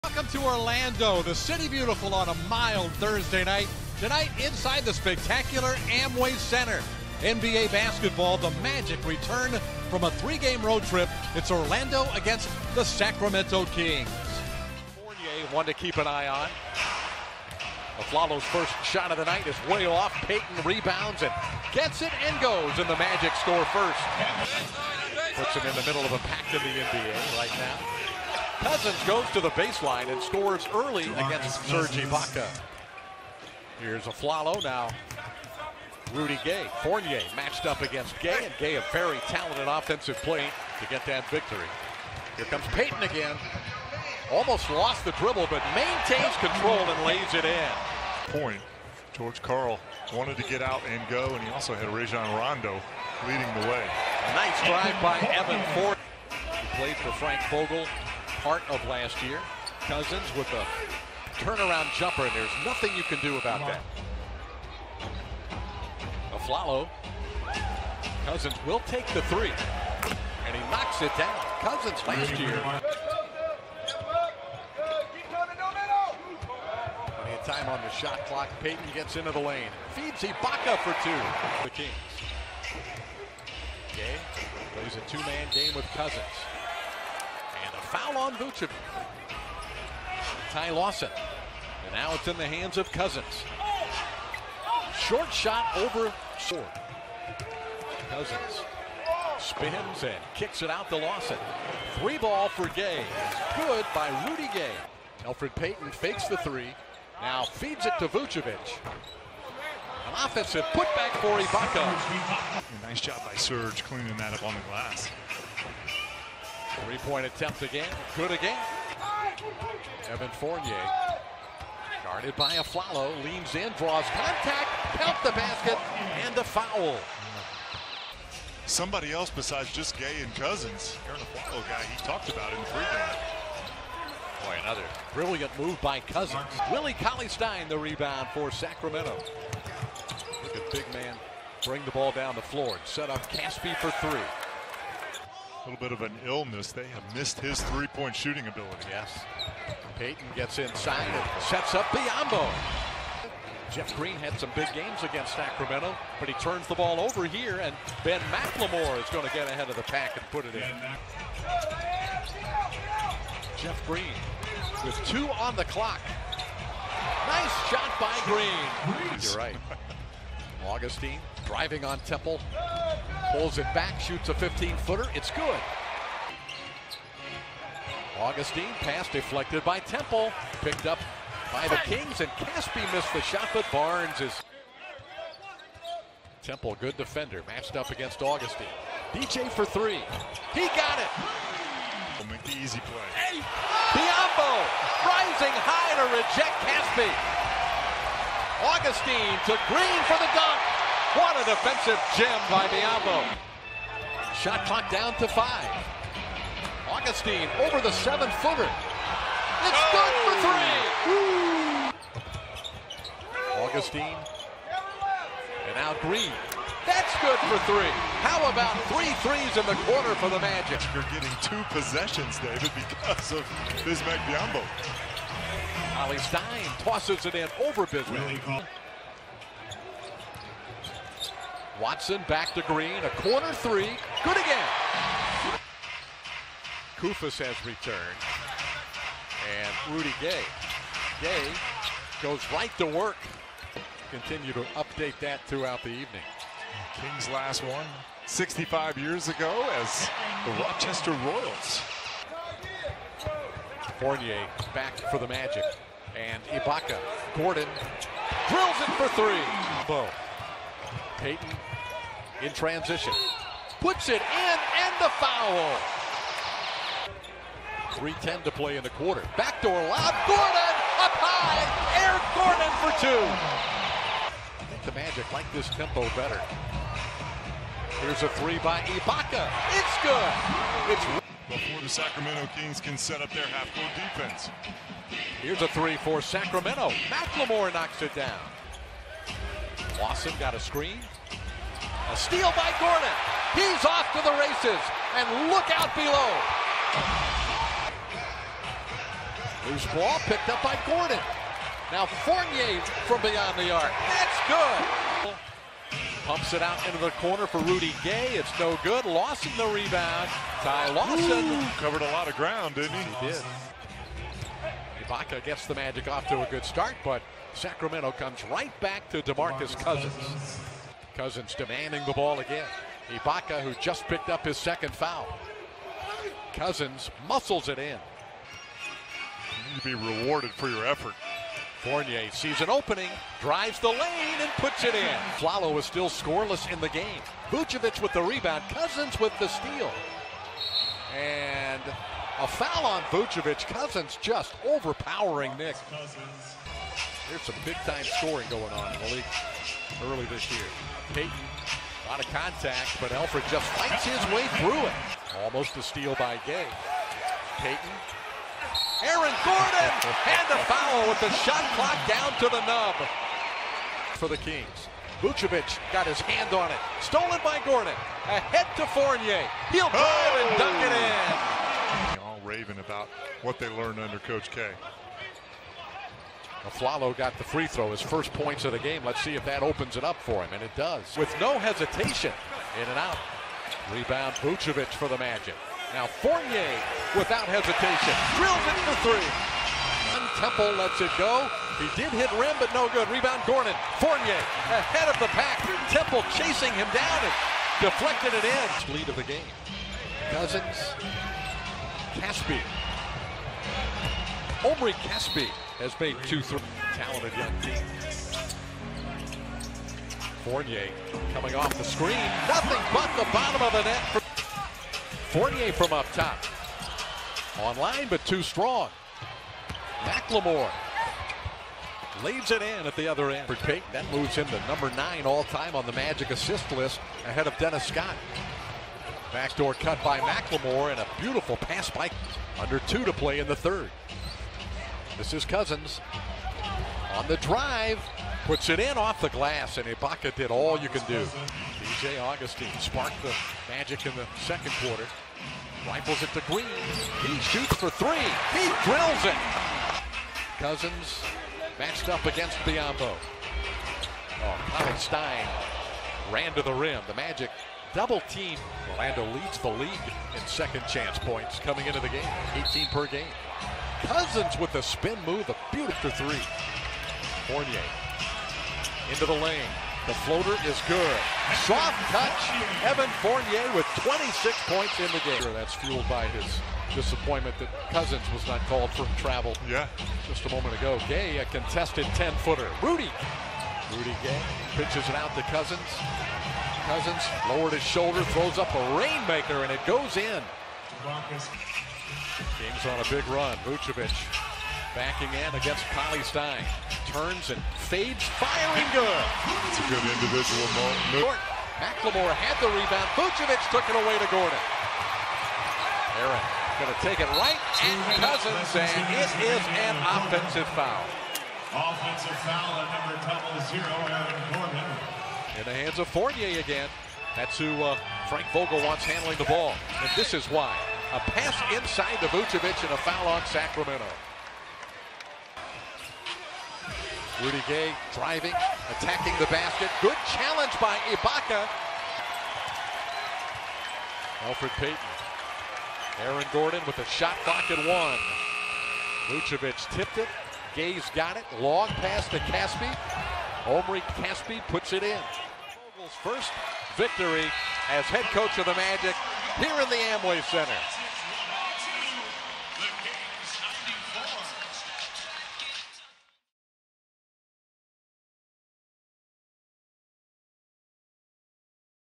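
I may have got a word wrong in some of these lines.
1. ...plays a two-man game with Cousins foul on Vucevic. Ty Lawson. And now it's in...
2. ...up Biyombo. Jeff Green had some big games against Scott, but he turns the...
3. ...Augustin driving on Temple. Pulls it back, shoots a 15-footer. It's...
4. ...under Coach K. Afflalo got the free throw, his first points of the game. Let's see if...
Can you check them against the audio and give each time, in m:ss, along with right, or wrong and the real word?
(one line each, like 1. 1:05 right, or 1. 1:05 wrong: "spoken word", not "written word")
1. 1:24 right
2. 2:31 wrong: "Sacramento", not "Scott"
3. 2:50 right
4. 6:13 right.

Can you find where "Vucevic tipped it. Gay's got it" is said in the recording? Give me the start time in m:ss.
8:59.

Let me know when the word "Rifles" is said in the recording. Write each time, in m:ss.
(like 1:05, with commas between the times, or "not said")
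7:25.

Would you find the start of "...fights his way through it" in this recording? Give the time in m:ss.
5:53.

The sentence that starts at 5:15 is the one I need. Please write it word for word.
Ibaka gets the Magic off to a good start, but Sacramento comes right back to DeMarcus Cousins.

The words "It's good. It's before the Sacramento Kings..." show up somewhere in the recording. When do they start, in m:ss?
4:39.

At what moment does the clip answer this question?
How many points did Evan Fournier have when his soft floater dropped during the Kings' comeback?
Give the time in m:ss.
7:53.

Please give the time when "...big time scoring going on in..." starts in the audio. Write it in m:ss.
5:47.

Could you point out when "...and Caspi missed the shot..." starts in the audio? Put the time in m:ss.
3:02.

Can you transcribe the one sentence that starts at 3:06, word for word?
Temple, good defender, matched up against Augustin.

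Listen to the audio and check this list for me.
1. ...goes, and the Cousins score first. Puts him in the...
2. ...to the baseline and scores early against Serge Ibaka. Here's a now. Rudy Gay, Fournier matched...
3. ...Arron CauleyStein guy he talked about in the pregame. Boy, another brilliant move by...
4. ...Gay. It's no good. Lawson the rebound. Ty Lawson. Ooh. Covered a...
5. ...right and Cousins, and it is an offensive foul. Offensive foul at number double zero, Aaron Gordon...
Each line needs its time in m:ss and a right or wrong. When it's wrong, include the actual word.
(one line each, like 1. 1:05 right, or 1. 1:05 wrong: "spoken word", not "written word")
1. 0:22 wrong: "Magic", not "Cousins"
2. 0:29 right
3. 2:11 wrong: "Afflalo", not "CauleyStein"
4. 5:08 right
5. 8:27 right.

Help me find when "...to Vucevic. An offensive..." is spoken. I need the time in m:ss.
1:47.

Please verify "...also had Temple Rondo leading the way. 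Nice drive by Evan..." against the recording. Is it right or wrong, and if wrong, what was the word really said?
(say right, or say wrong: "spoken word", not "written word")
wrong: "Rajon", not "Temple".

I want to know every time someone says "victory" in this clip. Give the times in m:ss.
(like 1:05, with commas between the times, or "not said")
0:41, 9:06.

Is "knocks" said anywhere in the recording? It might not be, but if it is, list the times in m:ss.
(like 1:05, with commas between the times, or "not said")
1:10, 4:47.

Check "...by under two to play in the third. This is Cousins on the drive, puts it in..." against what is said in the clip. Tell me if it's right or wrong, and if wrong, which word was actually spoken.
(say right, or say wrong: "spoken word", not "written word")
right.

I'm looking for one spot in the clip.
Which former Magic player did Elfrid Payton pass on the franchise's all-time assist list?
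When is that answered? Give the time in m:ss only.
7:07.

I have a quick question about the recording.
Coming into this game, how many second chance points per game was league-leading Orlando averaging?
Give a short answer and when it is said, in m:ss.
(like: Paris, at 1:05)
18, at 7:42.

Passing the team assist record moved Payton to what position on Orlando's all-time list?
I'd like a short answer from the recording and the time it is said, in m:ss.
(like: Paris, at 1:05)
9, at 7:04.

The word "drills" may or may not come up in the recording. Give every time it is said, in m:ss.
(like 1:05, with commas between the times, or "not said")
4:18, 6:28, 7:28.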